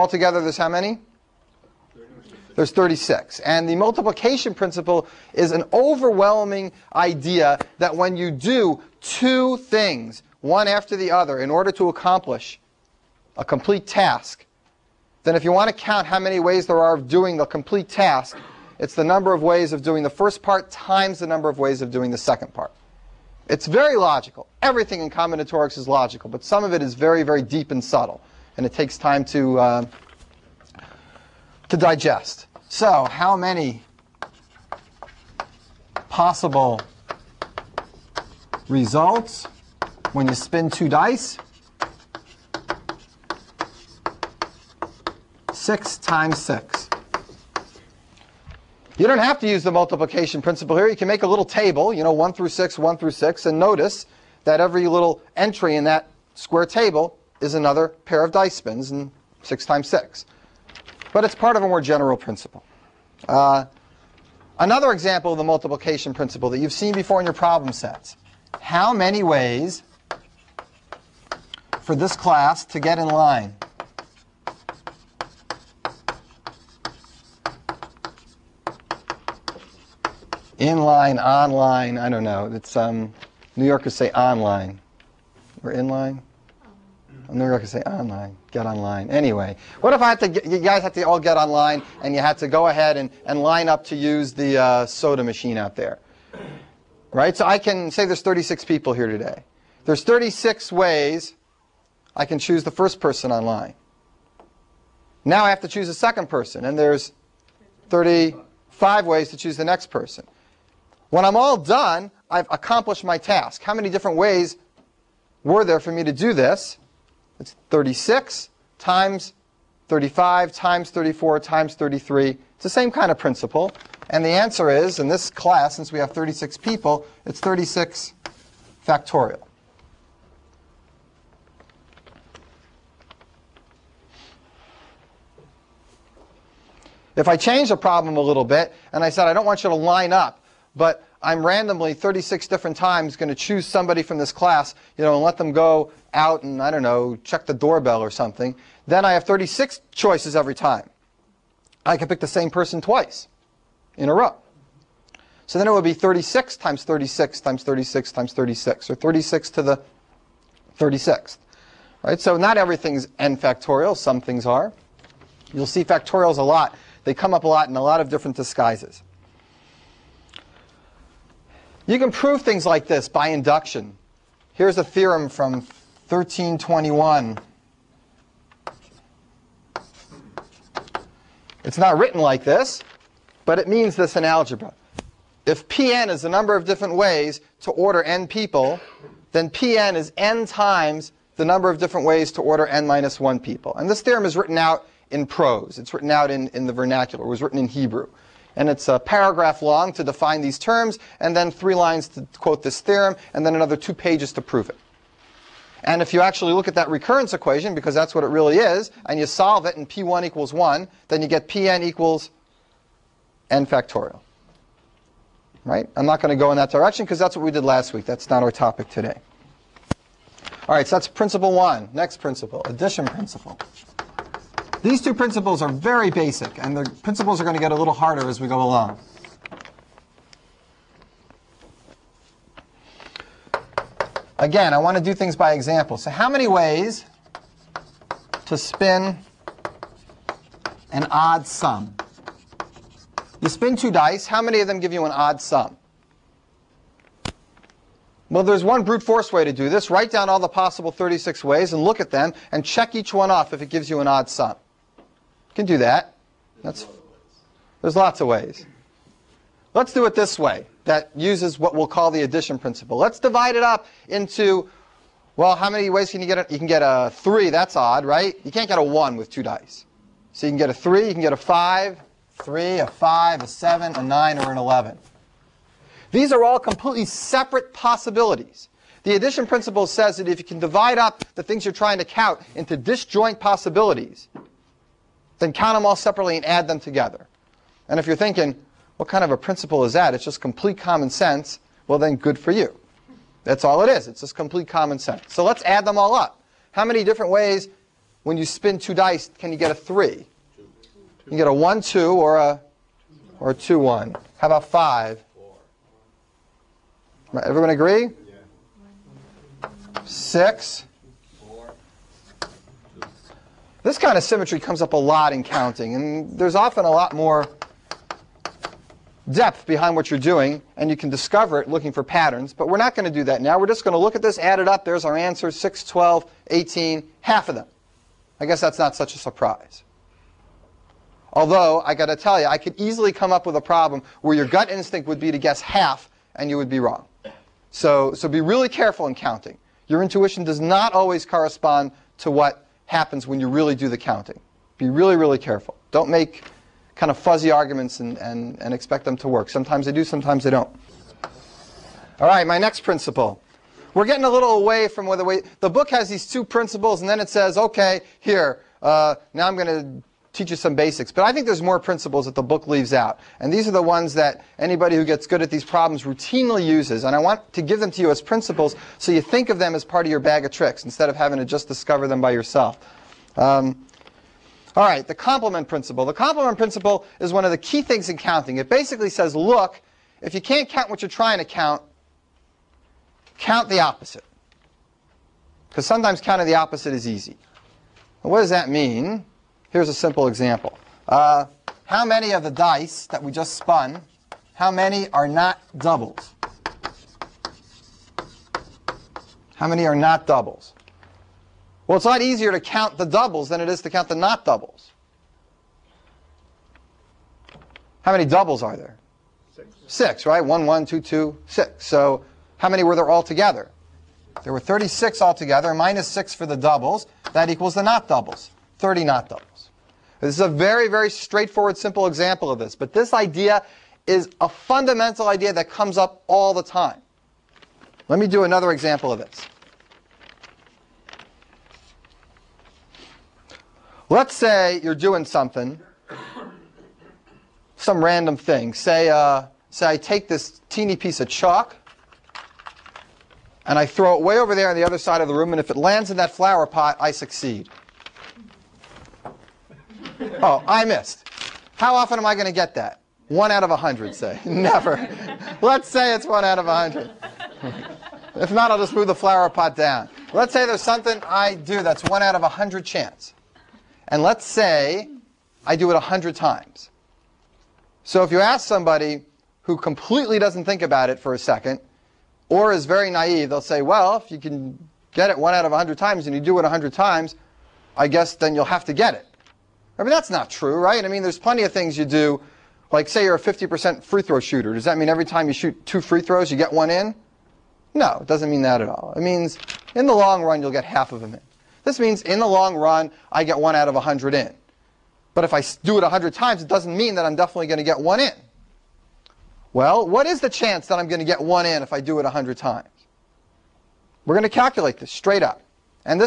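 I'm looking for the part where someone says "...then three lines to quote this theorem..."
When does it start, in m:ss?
3:21.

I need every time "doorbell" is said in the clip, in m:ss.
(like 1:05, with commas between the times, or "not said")
2:27.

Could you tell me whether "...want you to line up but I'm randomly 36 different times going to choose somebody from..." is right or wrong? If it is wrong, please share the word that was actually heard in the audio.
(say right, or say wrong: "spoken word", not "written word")
right.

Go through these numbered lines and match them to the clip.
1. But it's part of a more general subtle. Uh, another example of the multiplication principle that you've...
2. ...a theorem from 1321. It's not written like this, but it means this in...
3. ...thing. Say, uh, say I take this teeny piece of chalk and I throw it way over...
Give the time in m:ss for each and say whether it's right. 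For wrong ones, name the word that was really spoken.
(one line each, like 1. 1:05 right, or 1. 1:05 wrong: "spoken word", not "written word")
1. 1:01 wrong: "principle", not "subtle"
2. 2:54 right
3. 7:18 right.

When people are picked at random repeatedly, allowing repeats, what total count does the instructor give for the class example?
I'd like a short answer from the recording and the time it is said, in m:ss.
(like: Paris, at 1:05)
36 to the 36th, at 2:38.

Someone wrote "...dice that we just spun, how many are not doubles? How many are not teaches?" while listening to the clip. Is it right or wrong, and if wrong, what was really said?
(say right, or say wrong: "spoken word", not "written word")
wrong: "doubles", not "teaches".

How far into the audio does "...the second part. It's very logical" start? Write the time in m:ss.
0:22.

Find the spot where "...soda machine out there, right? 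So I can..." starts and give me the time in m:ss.
1:34.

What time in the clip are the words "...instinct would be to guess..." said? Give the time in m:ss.
5:34.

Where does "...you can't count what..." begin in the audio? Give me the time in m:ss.
6:20.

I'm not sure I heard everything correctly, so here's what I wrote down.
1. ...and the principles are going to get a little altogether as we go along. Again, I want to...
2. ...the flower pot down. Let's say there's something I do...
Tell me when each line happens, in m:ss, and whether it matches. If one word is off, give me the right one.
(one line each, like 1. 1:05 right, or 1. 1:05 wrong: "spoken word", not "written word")
1. 3:46 wrong: "harder", not "altogether"
2. 7:39 right.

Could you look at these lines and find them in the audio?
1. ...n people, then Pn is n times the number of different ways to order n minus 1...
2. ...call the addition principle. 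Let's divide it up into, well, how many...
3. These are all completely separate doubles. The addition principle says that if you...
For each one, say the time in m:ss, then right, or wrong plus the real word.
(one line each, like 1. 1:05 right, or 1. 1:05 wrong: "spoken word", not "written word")
1. 3:08 right
2. 4:21 right
3. 4:36 wrong: "possibilities", not "doubles".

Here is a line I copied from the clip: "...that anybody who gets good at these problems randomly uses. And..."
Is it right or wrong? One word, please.
wrong.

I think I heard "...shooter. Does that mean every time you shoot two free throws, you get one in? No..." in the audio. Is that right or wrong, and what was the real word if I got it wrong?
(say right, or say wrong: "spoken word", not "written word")
right.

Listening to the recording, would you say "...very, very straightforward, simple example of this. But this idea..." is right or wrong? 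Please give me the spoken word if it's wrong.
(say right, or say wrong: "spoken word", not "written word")
right.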